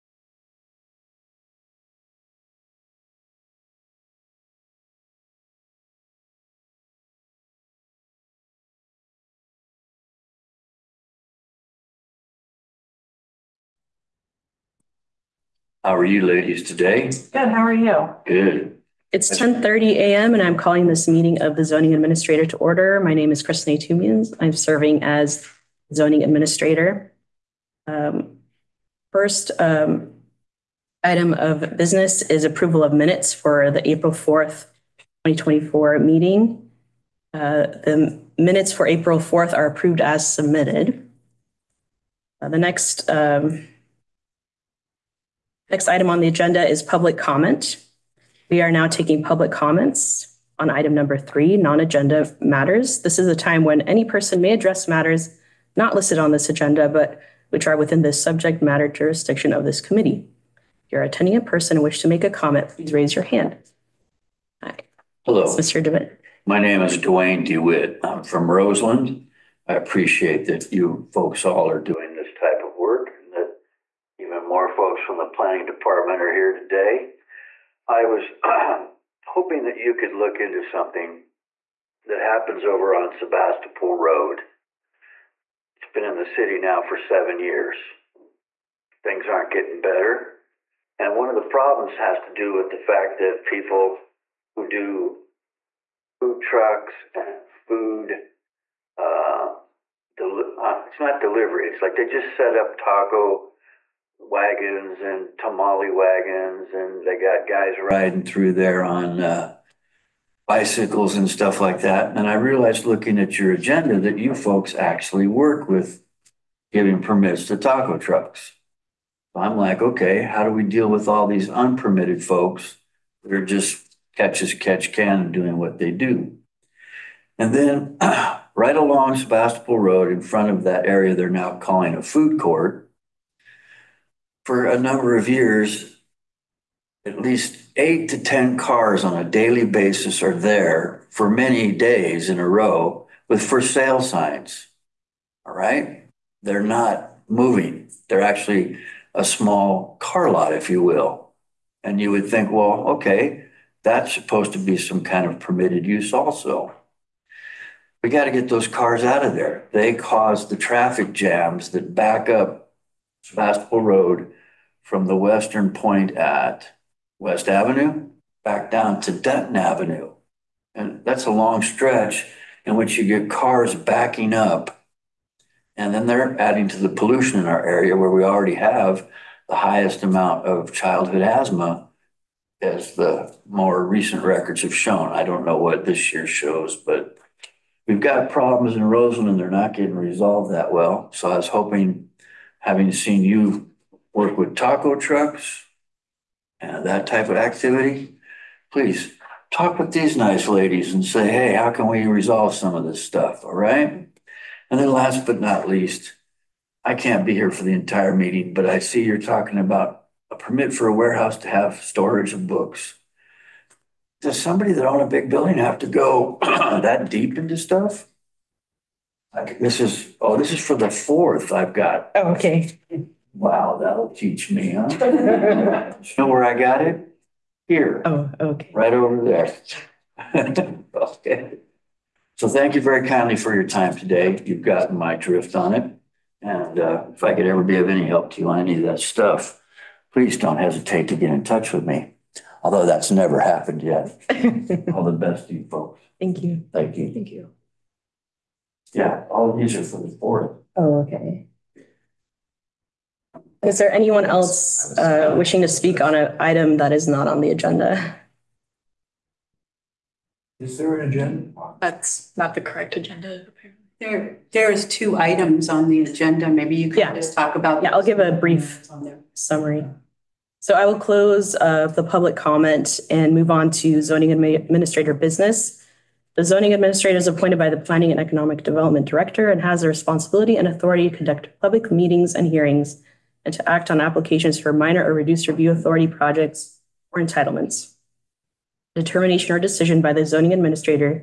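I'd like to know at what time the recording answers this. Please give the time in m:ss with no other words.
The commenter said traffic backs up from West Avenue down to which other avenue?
2:49.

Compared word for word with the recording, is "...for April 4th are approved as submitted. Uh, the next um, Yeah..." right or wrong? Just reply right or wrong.
wrong.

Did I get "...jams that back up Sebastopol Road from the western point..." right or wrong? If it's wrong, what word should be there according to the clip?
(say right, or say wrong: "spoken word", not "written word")
right.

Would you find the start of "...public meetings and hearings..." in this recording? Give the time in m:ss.
4:41.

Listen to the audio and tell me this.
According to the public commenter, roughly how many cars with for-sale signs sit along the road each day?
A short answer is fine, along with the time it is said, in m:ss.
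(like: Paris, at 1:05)
8 to 10, at 2:17.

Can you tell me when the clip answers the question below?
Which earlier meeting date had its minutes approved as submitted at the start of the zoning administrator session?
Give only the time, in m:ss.
0:33.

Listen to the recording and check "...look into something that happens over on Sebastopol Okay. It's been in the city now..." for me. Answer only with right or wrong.
wrong.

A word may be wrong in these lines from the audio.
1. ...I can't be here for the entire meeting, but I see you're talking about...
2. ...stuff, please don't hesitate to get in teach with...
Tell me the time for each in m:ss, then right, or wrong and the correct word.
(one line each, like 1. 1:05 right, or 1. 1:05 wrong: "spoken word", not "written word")
1. 3:26 right
2. 3:58 wrong: "touch", not "teach".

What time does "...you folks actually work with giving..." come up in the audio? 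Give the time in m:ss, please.
1:54.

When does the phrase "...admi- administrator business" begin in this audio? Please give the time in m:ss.
4:34.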